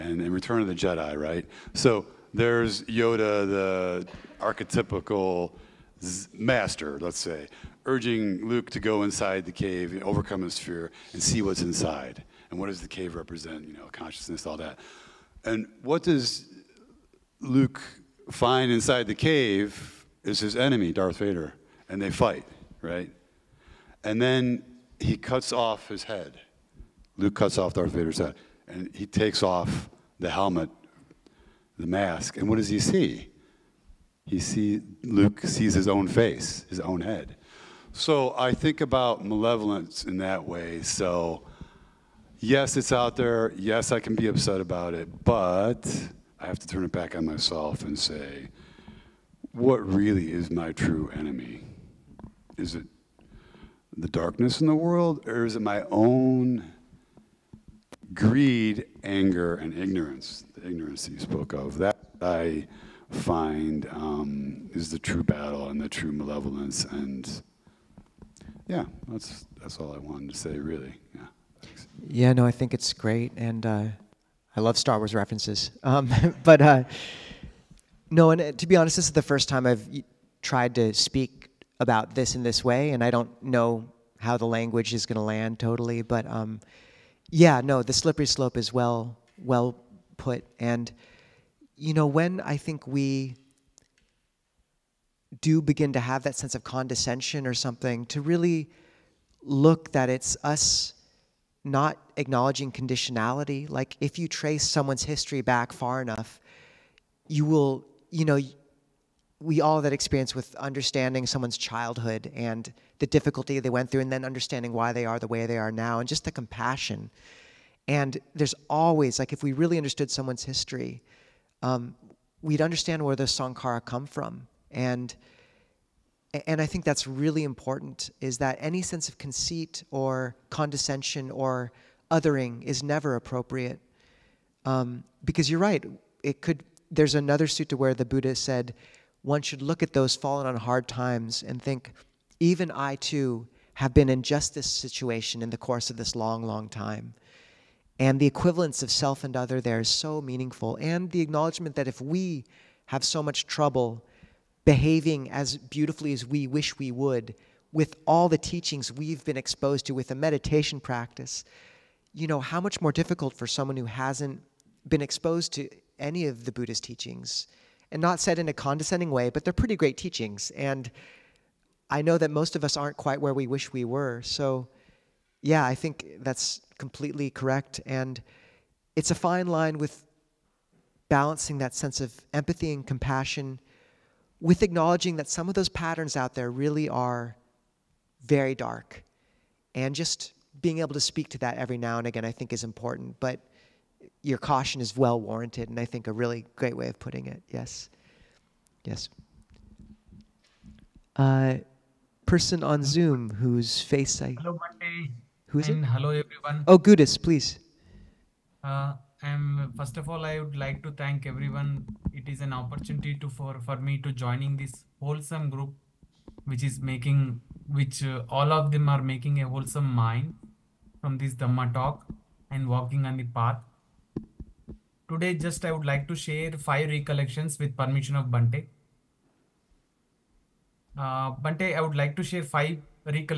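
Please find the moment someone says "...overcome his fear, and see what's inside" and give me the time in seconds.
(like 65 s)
10 s.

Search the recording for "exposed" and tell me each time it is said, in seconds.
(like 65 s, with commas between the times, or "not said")
159 s, 165 s.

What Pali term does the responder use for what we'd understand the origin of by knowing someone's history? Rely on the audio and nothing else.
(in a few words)
sankhara.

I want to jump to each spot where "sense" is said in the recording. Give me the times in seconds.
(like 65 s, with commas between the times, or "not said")
96 s, 128 s, 181 s.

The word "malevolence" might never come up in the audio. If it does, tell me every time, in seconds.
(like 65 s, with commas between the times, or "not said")
39 s, 66 s.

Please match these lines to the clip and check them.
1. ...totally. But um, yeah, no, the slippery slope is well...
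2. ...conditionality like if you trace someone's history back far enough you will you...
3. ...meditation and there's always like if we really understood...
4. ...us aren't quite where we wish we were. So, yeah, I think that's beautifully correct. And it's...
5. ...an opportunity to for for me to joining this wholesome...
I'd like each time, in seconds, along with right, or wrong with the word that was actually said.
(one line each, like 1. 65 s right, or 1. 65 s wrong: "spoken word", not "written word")
1. 85 s right
2. 102 s right
3. 116 s wrong: "compassion", not "meditation"
4. 172 s wrong: "completely", not "beautifully"
5. 212 s right.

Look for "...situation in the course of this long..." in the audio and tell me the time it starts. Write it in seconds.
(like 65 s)
144 s.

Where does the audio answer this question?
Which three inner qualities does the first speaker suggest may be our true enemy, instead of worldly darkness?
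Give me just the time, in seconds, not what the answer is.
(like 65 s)
58 s.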